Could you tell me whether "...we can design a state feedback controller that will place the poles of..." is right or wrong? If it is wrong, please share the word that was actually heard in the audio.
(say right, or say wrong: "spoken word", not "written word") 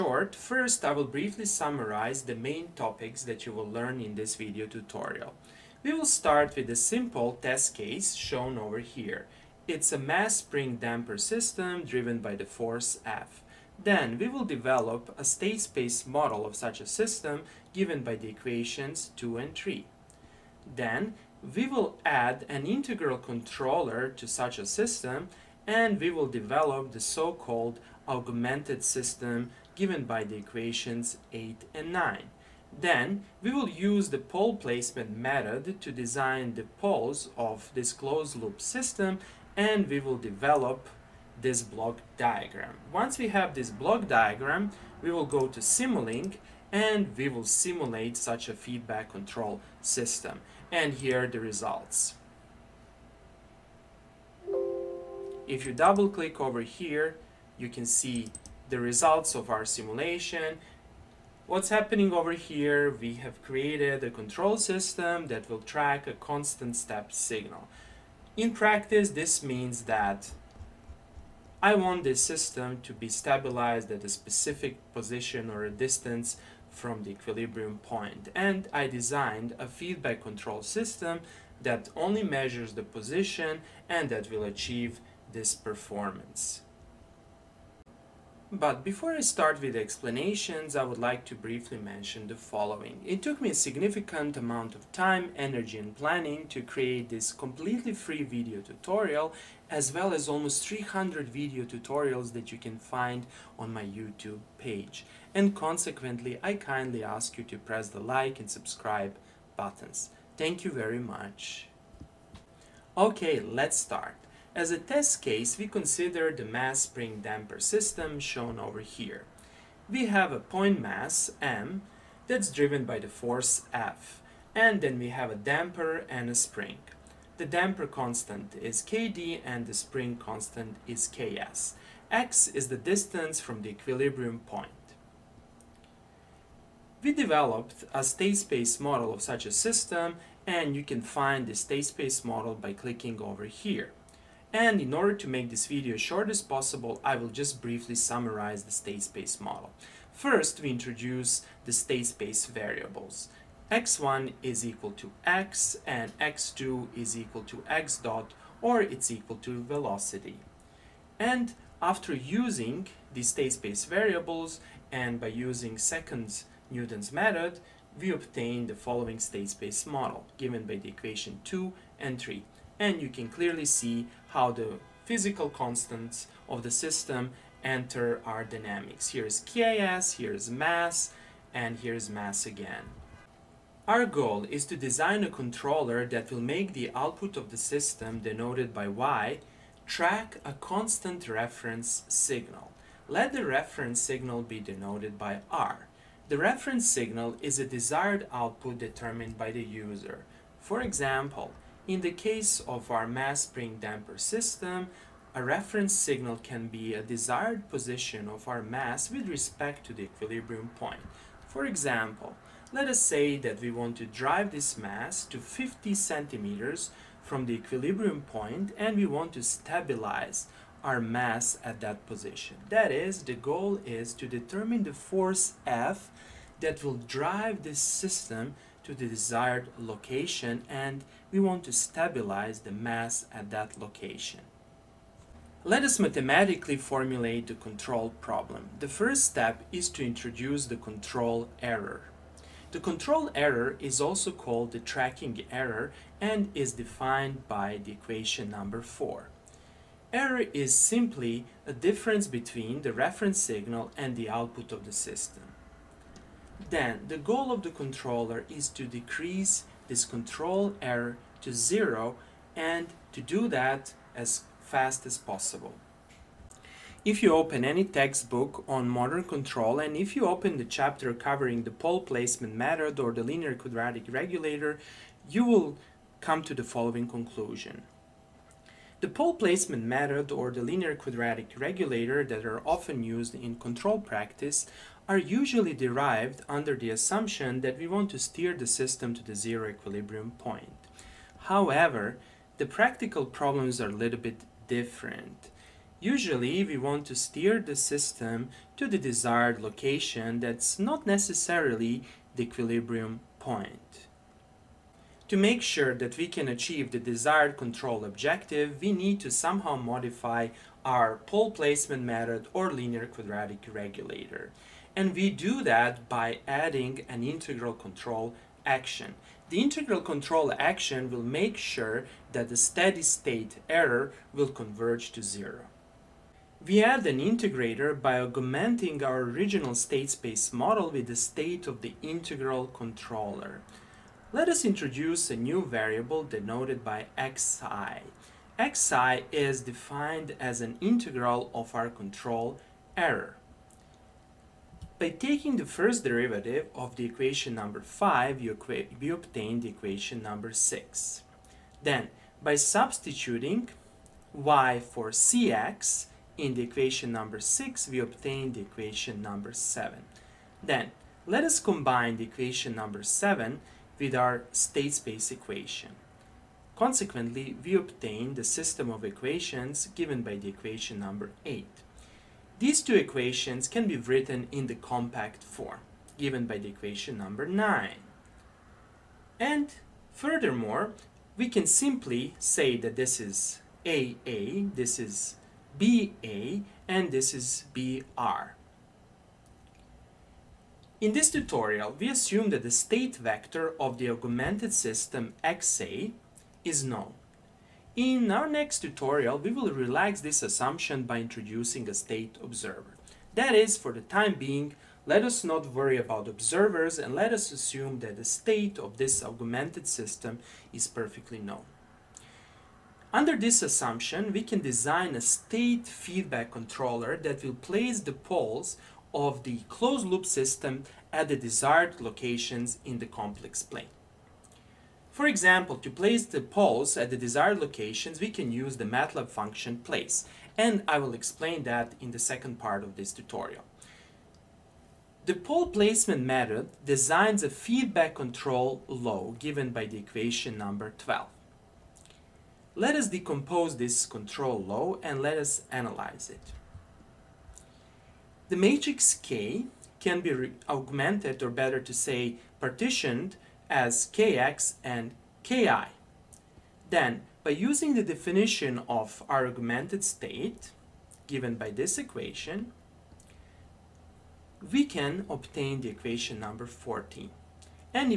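right.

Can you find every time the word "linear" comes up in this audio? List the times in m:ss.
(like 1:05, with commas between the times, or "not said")
4:33, 4:40, 5:12.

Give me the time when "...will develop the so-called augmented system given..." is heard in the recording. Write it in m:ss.
0:26.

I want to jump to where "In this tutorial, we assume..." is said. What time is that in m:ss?
6:31.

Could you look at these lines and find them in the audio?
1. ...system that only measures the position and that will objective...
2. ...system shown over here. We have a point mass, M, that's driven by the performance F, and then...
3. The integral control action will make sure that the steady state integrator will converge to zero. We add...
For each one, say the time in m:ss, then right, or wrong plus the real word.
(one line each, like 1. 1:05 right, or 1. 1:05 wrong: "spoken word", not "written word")
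1. 1:20 wrong: "achieve", not "objective"
2. 1:57 wrong: "force", not "performance"
3. 5:19 wrong: "error", not "integrator".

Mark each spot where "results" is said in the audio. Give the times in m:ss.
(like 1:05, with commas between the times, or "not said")
0:51, 0:58.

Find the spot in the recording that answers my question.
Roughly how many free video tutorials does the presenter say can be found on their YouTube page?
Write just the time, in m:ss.
1:40.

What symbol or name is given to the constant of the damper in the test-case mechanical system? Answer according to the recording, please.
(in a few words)
Kd.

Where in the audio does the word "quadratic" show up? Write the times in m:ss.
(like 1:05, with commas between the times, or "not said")
4:33, 4:40, 5:13.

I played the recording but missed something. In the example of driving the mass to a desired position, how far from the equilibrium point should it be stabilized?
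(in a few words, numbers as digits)
50 centimeters.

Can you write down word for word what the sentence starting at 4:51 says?
However, the practical problems are a little bit different.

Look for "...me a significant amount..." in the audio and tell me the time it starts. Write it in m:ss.
1:33.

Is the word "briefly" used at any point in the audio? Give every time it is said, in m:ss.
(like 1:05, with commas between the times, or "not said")
0:01, 1:31, 2:27.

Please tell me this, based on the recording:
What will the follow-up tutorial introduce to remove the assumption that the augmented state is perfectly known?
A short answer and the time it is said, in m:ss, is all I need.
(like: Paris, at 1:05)
a state observer, at 6:41.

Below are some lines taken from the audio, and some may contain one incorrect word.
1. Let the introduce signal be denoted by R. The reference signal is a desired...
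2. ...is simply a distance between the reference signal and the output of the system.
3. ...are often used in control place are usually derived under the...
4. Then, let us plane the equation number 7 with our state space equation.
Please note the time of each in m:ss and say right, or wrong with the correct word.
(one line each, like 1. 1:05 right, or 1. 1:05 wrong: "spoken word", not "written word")
1. 3:13 wrong: "reference", not "introduce"
2. 4:10 wrong: "difference", not "distance"
3. 4:42 wrong: "practice", not "place"
4. 6:00 wrong: "combine", not "plane".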